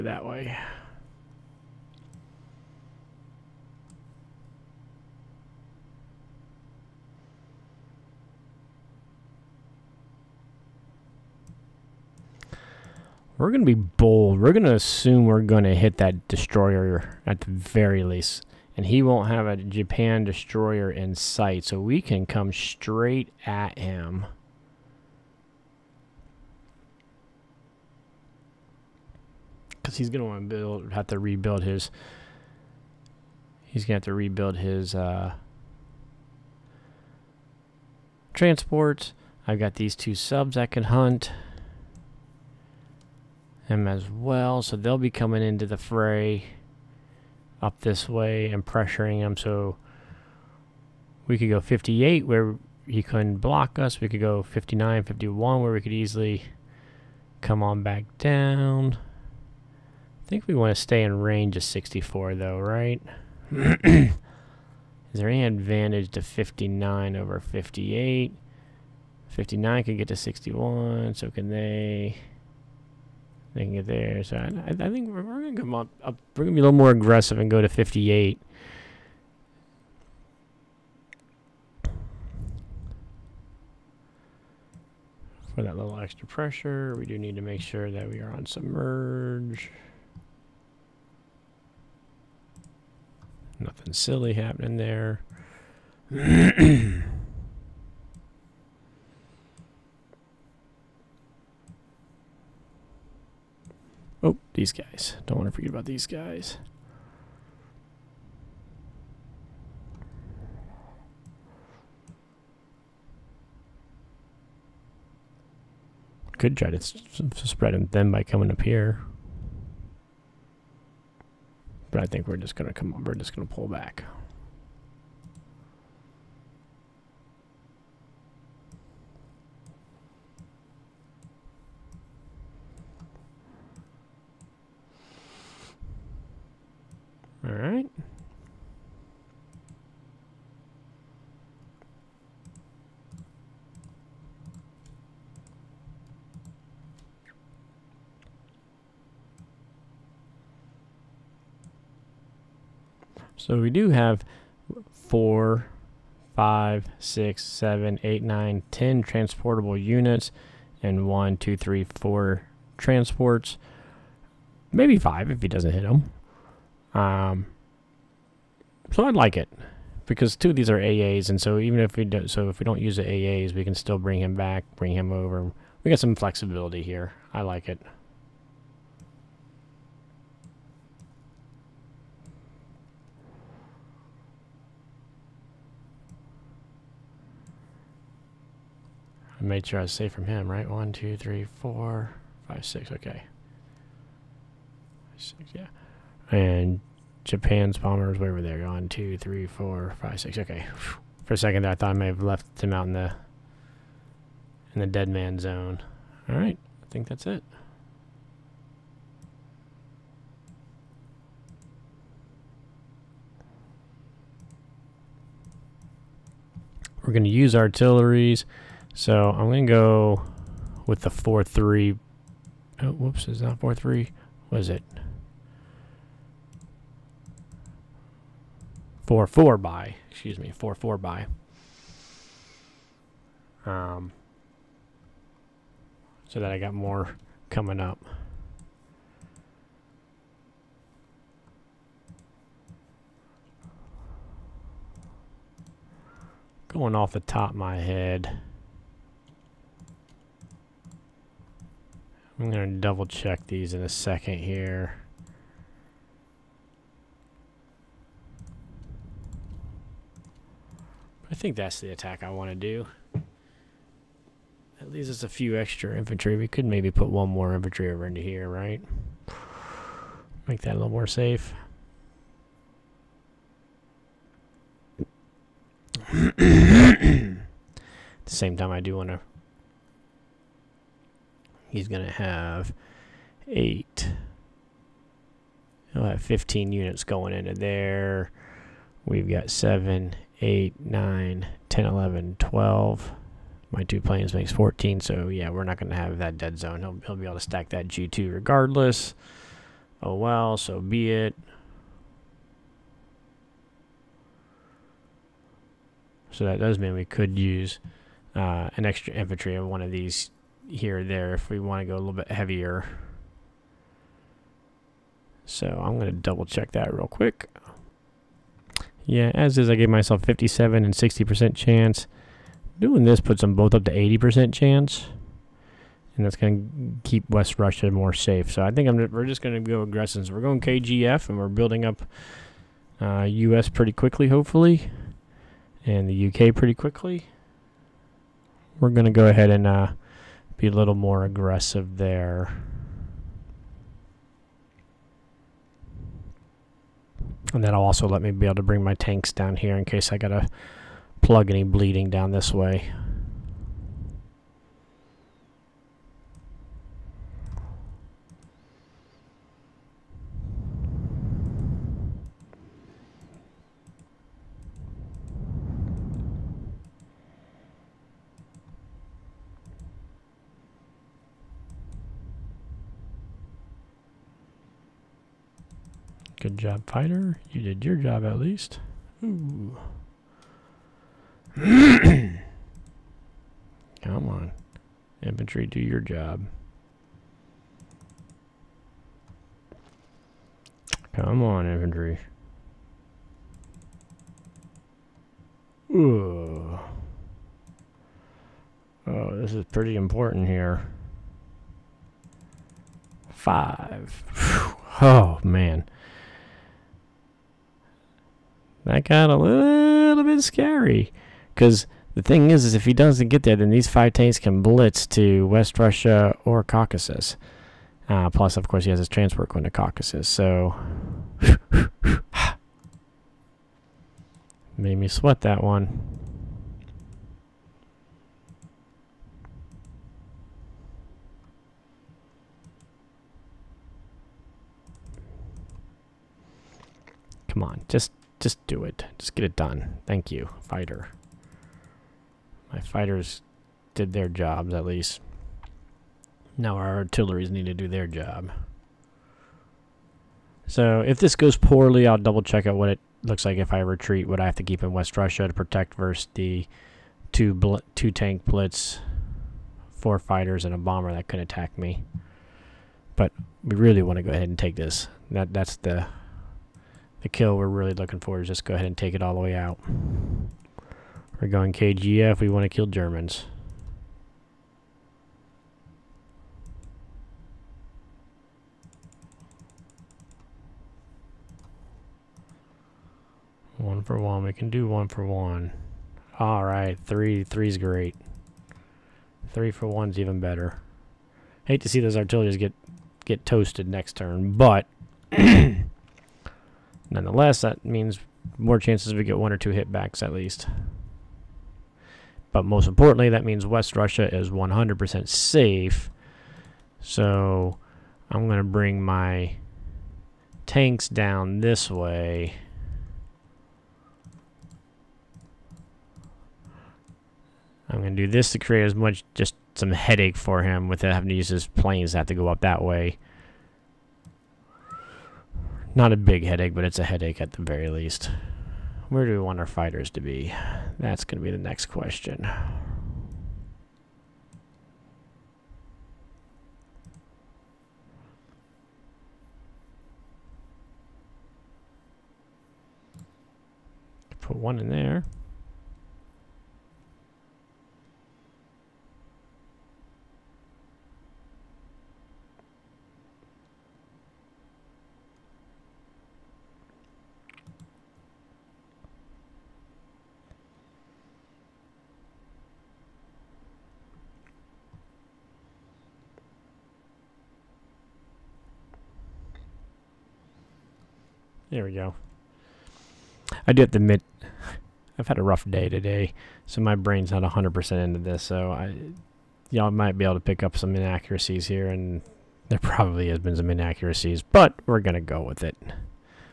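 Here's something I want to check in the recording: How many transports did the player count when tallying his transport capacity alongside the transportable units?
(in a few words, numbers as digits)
4.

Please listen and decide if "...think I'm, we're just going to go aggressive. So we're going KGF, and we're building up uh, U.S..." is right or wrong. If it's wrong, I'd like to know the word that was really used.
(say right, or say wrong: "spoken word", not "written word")
right.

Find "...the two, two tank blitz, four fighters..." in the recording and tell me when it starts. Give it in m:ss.
7:36.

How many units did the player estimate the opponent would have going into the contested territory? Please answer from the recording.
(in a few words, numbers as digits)
15.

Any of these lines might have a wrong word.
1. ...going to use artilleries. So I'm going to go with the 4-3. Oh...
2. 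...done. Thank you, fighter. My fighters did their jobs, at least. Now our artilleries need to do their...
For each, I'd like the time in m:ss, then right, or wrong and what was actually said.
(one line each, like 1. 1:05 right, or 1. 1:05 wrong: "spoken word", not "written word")
1. 3:37 right
2. 7:19 right.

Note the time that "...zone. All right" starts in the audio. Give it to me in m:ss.
3:25.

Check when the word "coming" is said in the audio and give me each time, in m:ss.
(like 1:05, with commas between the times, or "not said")
0:45, 1:58, 3:57.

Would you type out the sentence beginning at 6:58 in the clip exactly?
Uh, plus, of course, he has his transport going to Caucasus, so...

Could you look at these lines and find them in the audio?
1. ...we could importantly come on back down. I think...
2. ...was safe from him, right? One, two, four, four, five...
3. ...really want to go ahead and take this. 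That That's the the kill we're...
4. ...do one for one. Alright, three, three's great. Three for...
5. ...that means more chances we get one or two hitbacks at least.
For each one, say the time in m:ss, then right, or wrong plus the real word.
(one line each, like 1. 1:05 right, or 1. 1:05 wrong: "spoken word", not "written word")
1. 0:55 wrong: "easily", not "importantly"
2. 3:09 wrong: "three", not "four"
3. 7:43 right
4. 8:04 right
5. 8:17 right.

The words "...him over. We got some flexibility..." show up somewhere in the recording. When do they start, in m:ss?
2:54.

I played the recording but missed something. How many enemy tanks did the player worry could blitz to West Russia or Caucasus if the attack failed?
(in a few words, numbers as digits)
5.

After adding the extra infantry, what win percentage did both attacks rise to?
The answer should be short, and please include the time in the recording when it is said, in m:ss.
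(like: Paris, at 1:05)
80%, at 5:23.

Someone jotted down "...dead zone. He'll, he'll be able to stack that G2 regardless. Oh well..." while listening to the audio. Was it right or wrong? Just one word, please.
right.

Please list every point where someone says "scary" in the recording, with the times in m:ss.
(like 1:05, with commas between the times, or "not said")
6:50.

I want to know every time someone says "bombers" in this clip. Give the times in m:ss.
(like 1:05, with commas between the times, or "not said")
3:17, 7:40.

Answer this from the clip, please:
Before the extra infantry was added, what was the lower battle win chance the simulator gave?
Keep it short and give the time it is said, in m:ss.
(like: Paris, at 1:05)
57%, at 5:20.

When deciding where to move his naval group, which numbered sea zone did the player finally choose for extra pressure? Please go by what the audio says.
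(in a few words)
58.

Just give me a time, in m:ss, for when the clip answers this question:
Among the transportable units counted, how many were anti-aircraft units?
2:50.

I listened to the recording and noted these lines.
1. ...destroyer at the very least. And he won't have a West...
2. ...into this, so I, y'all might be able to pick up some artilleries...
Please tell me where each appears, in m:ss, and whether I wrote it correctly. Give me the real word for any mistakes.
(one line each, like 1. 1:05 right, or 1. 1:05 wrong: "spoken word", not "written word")
1. 0:16 wrong: "Japan", not "West"
2. 9:38 wrong: "inaccuracies", not "artilleries".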